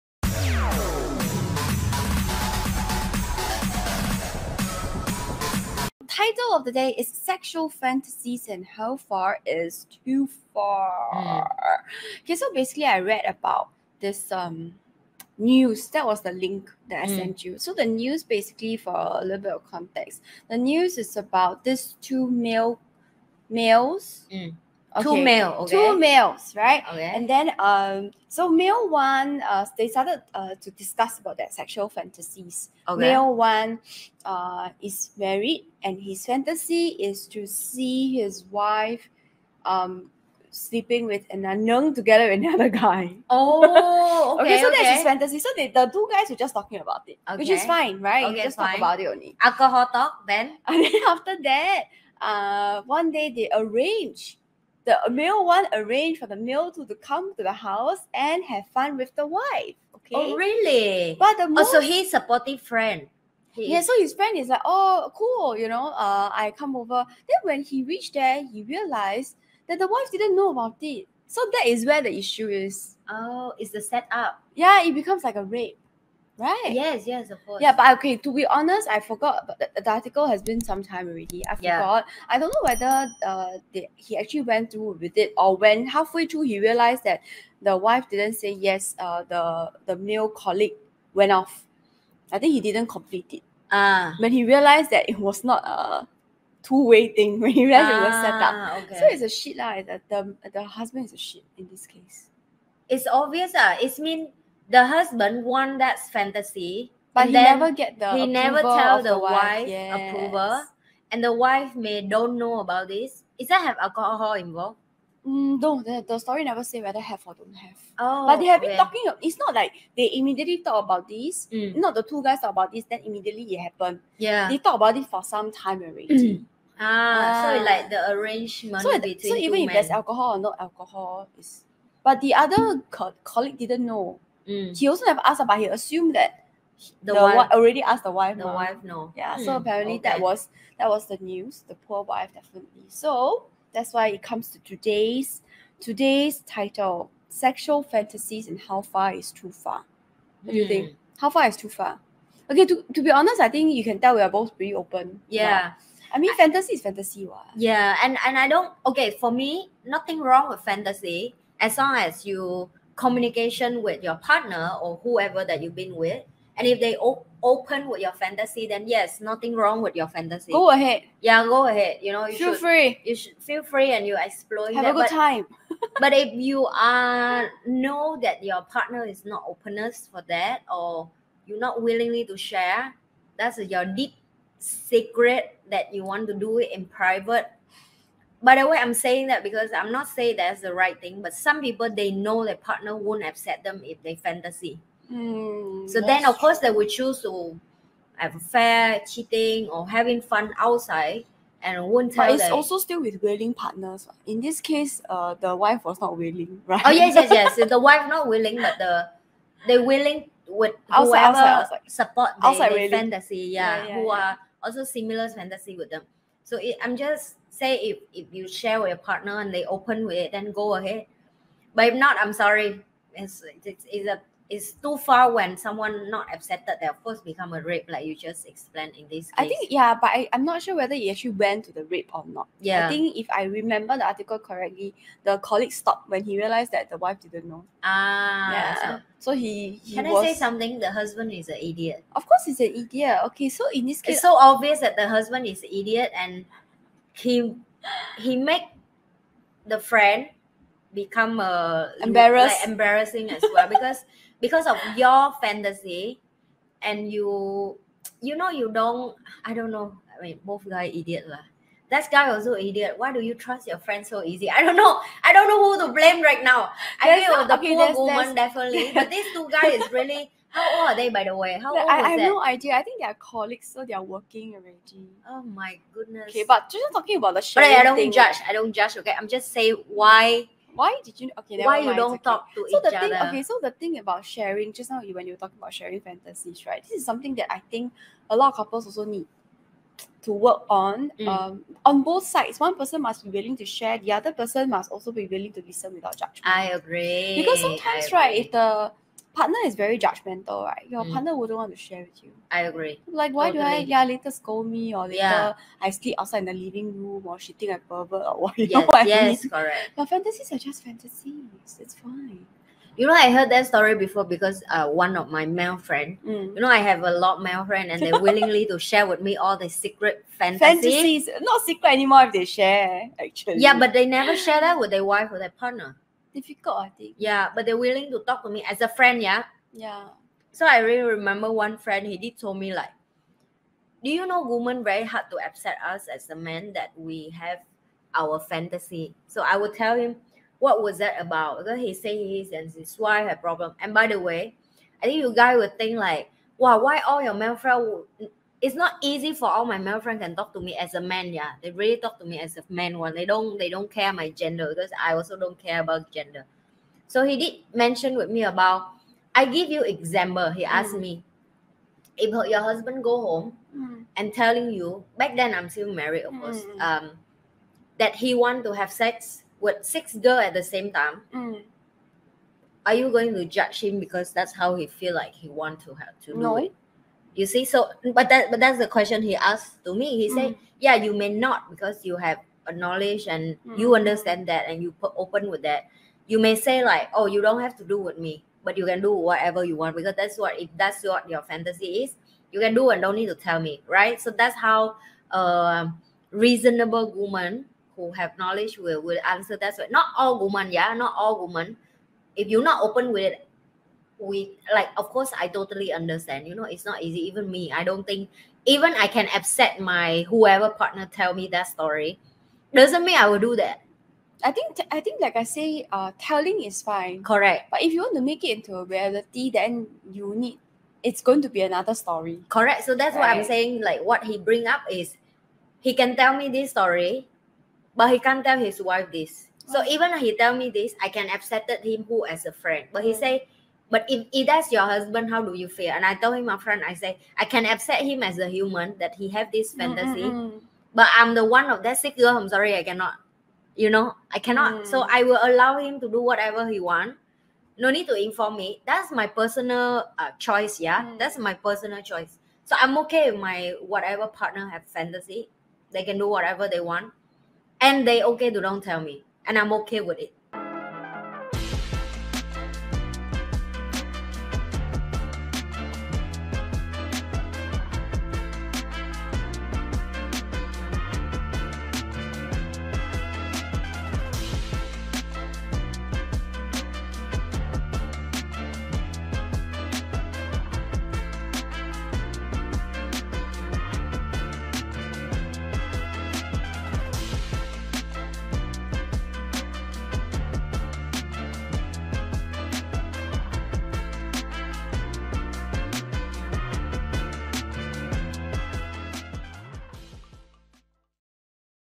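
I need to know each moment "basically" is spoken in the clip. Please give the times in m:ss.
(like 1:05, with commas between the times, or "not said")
0:12, 0:18.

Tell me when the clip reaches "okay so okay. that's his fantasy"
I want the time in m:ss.
0:44.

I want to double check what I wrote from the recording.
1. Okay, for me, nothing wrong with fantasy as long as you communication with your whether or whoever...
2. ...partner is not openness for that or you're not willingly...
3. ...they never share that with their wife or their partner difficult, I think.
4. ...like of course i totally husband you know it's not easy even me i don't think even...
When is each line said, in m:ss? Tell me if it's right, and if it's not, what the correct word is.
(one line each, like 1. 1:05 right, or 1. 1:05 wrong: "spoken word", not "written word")
1. 2:38 wrong: "partner", not "whether"
2. 2:58 right
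3. 5:23 right
4. 6:44 wrong: "understand", not "husband".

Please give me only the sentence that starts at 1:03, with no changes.
so his friend is like, oh, cool, you know, uh, I come over.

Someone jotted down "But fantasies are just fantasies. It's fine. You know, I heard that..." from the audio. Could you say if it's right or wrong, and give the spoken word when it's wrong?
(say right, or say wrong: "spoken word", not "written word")
right.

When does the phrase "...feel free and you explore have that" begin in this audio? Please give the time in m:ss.
2:53.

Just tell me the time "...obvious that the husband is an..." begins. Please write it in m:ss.
4:04.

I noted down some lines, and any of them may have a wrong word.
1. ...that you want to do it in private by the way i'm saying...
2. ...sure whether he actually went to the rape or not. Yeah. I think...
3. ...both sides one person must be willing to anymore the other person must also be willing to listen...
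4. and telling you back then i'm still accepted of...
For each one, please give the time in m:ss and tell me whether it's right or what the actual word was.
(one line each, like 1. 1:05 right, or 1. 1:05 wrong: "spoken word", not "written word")
1. 3:05 right
2. 3:50 right
3. 4:52 wrong: "share", not "anymore"
4. 6:04 wrong: "married", not "accepted".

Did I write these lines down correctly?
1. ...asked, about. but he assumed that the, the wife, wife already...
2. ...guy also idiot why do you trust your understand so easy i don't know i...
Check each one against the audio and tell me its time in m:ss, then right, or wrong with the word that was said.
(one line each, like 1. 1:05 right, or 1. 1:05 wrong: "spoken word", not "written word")
1. 2:15 right
2. 4:22 wrong: "friend", not "understand".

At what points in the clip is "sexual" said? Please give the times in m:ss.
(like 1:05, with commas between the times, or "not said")
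0:07, 0:31, 2:27.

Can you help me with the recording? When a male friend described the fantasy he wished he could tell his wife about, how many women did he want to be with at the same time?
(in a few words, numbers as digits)
6.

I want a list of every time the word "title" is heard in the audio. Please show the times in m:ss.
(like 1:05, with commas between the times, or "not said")
0:06, 2:26.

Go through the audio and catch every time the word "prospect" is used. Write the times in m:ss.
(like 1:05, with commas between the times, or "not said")
not said.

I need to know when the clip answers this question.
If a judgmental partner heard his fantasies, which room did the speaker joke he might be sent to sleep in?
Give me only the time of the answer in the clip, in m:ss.
5:06.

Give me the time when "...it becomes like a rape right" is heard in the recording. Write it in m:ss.
1:14.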